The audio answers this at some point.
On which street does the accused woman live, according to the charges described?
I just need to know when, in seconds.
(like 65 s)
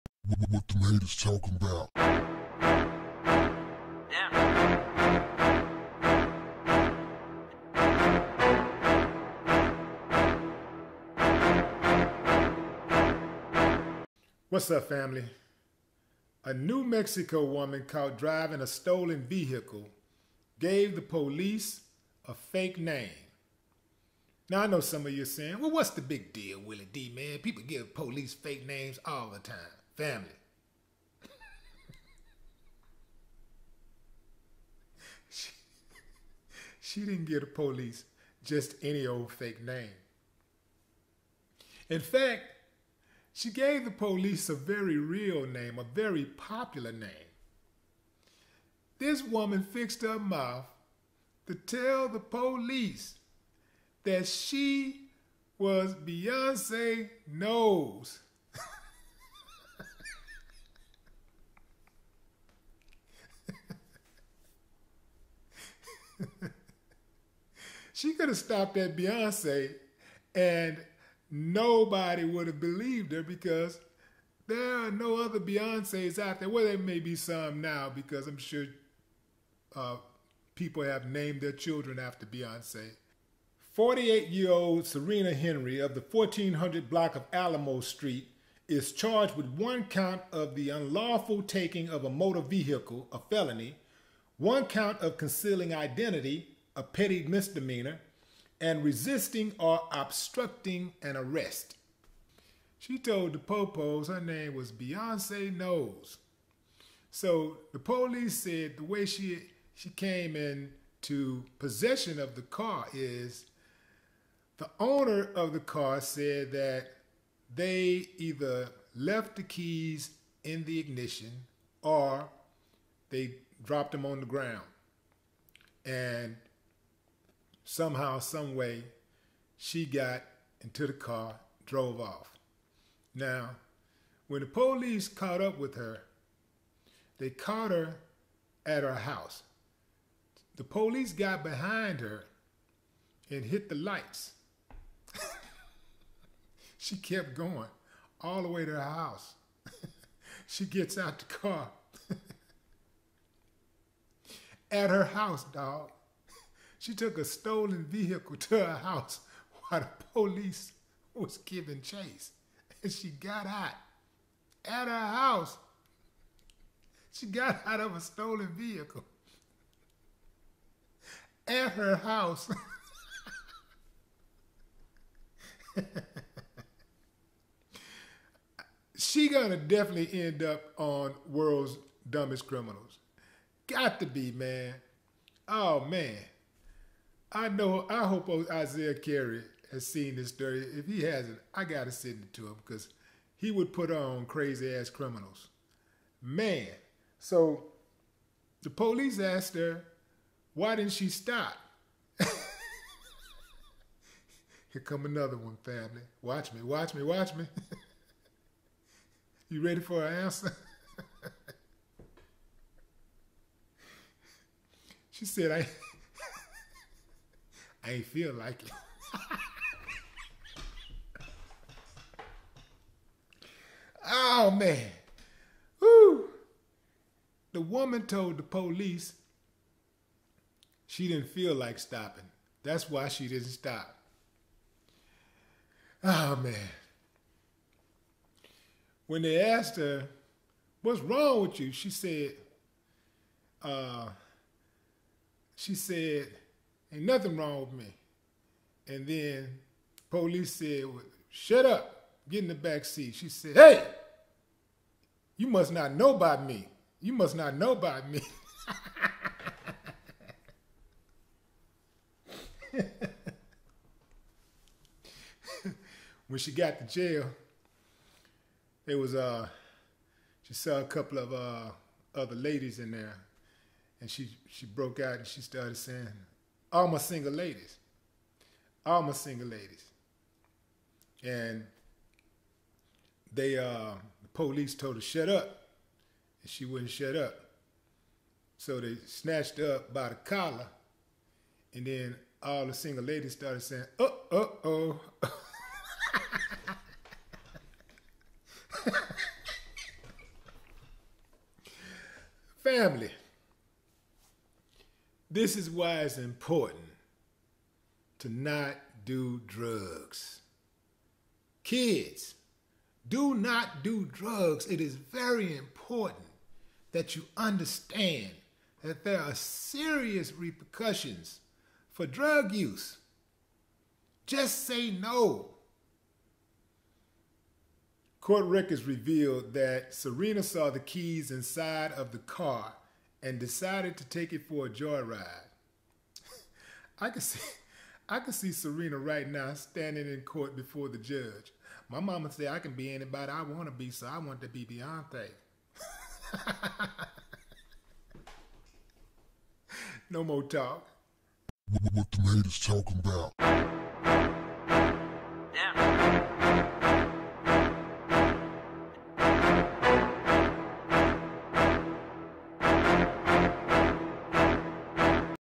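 87 s.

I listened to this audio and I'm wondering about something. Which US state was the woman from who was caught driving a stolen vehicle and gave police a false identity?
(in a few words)
New Mexico.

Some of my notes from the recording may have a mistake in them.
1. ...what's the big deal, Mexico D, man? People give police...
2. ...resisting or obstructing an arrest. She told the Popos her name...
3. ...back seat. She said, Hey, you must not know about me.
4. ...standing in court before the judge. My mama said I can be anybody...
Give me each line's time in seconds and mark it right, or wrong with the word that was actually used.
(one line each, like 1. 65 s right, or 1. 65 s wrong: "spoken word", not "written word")
1. 25 s wrong: "Willie", not "Mexico"
2. 98 s right
3. 252 s right
4. 339 s right.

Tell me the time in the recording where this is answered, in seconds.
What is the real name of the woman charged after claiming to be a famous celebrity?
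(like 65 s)
84 s.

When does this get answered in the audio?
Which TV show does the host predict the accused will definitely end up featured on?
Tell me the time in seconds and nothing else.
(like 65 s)
181 s.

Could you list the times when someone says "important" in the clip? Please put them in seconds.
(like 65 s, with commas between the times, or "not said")
306 s, 315 s.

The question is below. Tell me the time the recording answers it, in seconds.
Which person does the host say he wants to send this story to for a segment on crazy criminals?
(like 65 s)
188 s.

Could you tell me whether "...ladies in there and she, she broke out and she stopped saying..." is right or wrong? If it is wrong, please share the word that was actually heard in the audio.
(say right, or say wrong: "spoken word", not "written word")
wrong: "started", not "stopped".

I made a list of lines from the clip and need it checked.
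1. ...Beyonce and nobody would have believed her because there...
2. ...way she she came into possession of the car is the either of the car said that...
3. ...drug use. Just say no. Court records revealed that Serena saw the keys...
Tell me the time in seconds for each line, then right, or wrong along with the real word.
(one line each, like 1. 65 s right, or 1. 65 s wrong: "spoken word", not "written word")
1. 68 s right
2. 108 s wrong: "owner", not "either"
3. 322 s right.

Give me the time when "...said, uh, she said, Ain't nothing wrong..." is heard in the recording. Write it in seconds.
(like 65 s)
241 s.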